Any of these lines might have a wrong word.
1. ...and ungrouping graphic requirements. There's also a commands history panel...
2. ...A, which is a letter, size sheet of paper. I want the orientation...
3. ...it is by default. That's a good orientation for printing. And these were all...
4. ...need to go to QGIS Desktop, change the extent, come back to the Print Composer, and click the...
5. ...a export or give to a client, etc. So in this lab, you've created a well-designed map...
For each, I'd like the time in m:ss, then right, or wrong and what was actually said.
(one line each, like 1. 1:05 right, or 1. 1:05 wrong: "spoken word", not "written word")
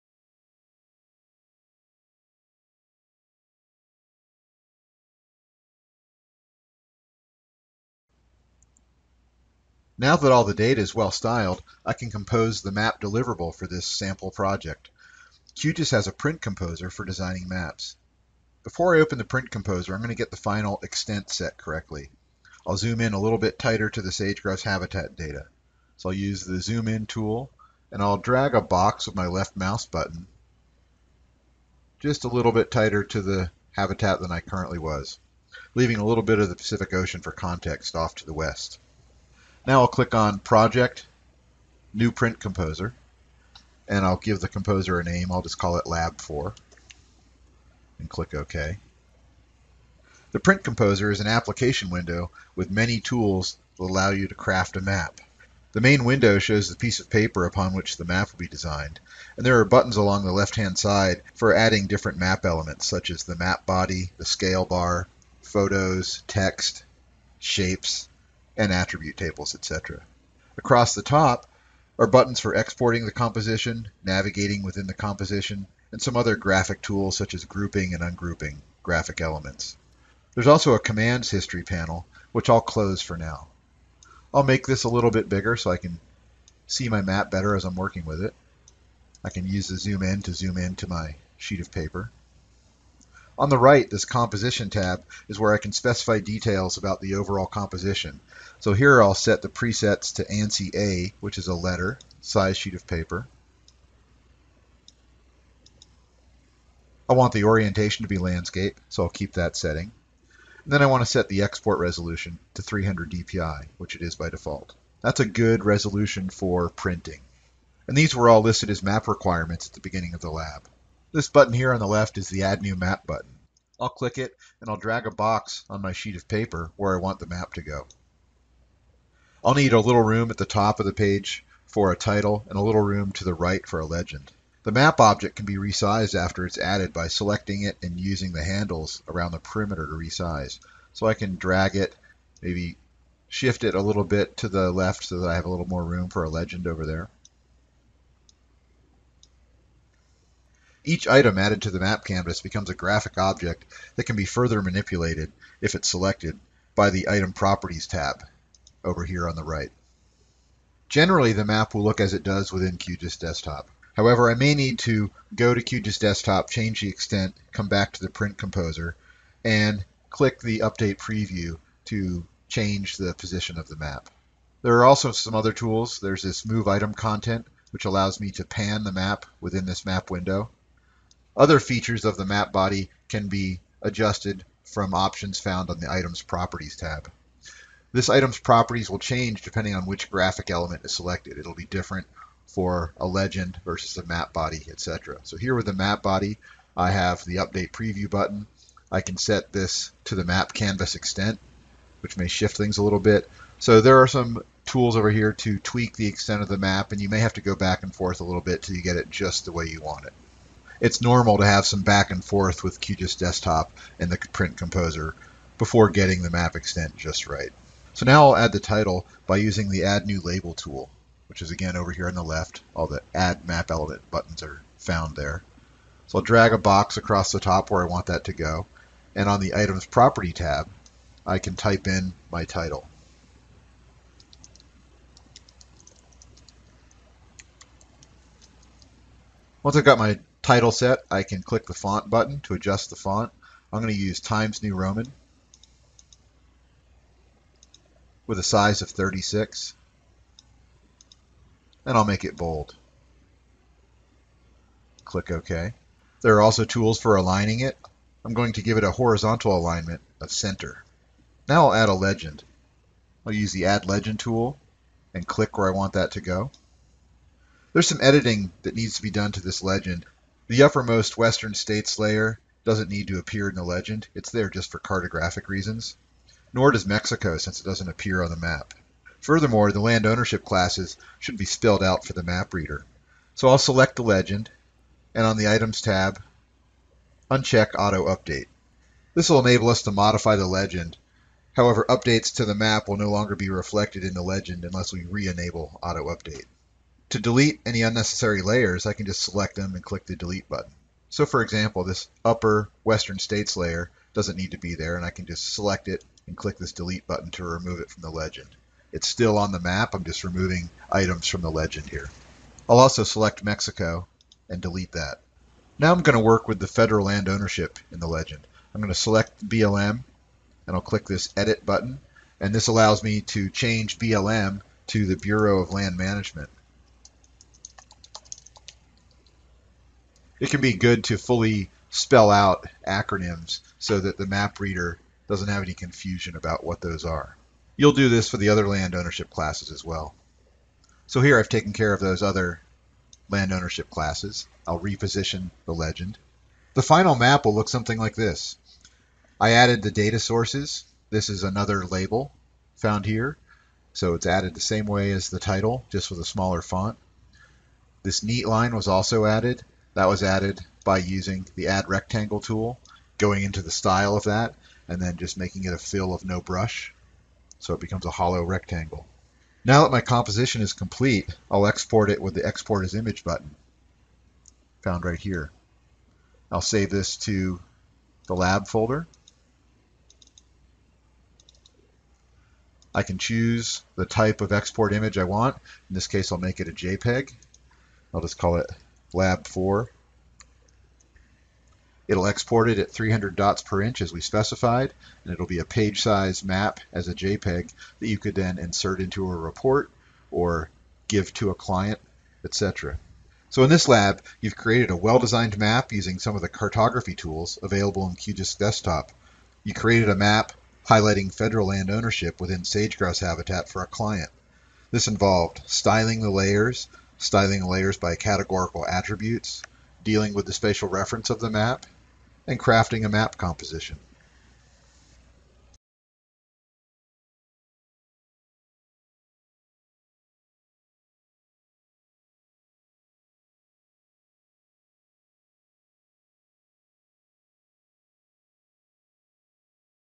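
1. 1:17 wrong: "elements", not "requirements"
2. 1:40 right
3. 1:53 wrong: "resolution", not "orientation"
4. 2:44 right
5. 6:39 wrong: "report", not "export".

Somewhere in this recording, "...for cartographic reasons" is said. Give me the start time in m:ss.
4:34.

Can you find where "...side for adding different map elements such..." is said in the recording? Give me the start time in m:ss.
1:00.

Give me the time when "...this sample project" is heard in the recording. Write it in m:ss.
0:13.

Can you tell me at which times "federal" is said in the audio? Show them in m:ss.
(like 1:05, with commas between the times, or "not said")
5:16, 6:51.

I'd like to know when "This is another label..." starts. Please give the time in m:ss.
5:51.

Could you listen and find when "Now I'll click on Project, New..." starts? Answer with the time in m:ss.
0:39.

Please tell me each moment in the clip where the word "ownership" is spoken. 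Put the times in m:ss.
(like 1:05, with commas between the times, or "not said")
4:40, 5:17, 5:38, 5:43, 6:51.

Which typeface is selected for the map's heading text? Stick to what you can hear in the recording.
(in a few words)
Times New Roman.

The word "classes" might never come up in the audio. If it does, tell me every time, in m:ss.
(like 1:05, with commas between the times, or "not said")
4:40, 5:39, 5:43.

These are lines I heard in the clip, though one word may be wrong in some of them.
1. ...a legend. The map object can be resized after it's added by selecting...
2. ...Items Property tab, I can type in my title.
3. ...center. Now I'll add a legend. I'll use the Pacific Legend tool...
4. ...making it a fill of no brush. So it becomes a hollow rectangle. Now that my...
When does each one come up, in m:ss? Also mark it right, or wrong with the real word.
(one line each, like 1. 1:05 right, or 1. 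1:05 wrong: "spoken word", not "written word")
1. 2:13 right
2. 3:49 right
3. 4:20 wrong: "Add", not "Pacific"
4. 6:05 right.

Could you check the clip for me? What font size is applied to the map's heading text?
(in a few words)
36.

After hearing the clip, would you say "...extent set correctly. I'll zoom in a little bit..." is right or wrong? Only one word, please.
right.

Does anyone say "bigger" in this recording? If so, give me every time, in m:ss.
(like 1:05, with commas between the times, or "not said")
1:25.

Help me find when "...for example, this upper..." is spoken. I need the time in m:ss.
5:01.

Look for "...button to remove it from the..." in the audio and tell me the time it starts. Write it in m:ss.
5:07.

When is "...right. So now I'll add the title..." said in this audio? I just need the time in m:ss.
3:37.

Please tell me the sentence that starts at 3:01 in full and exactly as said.
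Other features of the map body can be adjusted from options found on the Items Properties tab.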